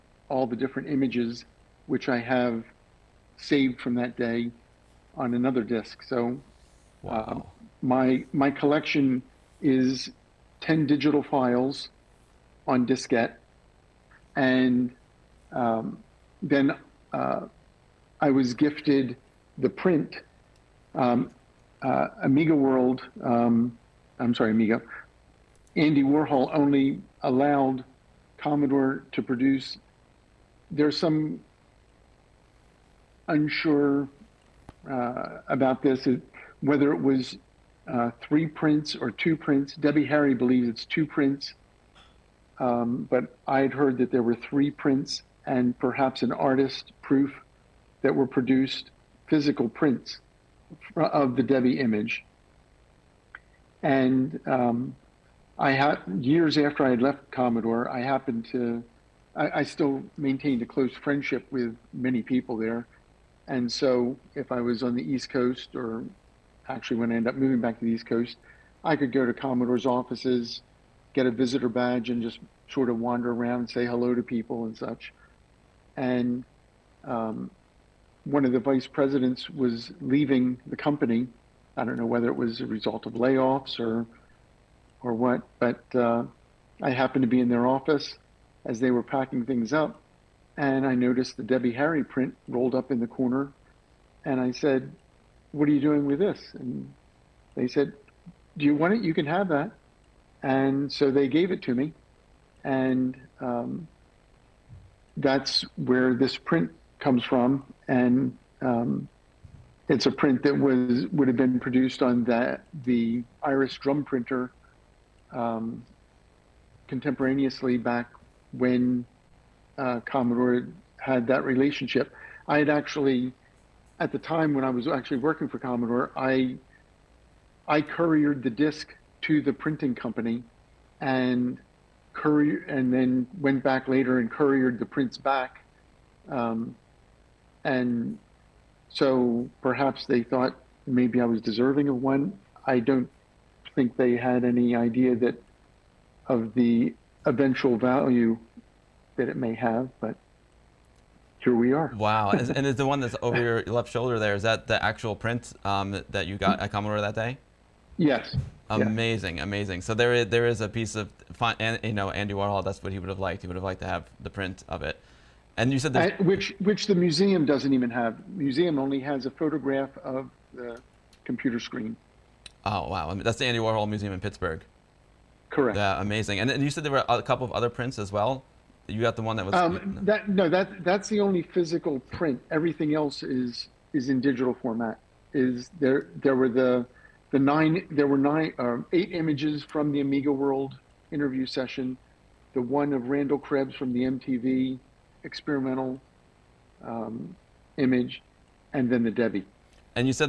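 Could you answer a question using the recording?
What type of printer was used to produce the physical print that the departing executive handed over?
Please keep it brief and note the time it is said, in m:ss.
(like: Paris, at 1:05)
Iris drum printer, at 1:53.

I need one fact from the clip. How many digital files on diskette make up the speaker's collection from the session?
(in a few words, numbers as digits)
10.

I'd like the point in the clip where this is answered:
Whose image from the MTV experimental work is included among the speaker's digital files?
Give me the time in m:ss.
3:13.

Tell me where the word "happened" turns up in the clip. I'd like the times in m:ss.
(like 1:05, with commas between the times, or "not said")
0:58, 1:26.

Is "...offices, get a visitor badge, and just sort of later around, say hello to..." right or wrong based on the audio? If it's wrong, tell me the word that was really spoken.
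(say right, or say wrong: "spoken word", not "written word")
wrong: "wander", not "later".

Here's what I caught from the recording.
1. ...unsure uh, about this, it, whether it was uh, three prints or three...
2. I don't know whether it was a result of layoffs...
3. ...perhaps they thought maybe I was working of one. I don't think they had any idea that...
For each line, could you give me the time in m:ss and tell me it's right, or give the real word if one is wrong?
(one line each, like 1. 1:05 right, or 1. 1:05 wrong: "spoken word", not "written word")
1. 0:33 wrong: "two", not "three"
2. 1:21 right
3. 2:19 wrong: "deserving", not "working".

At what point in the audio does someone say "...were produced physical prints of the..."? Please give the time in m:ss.
0:48.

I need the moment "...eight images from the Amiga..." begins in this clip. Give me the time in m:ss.
3:08.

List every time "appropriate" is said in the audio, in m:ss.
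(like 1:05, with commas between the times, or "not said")
not said.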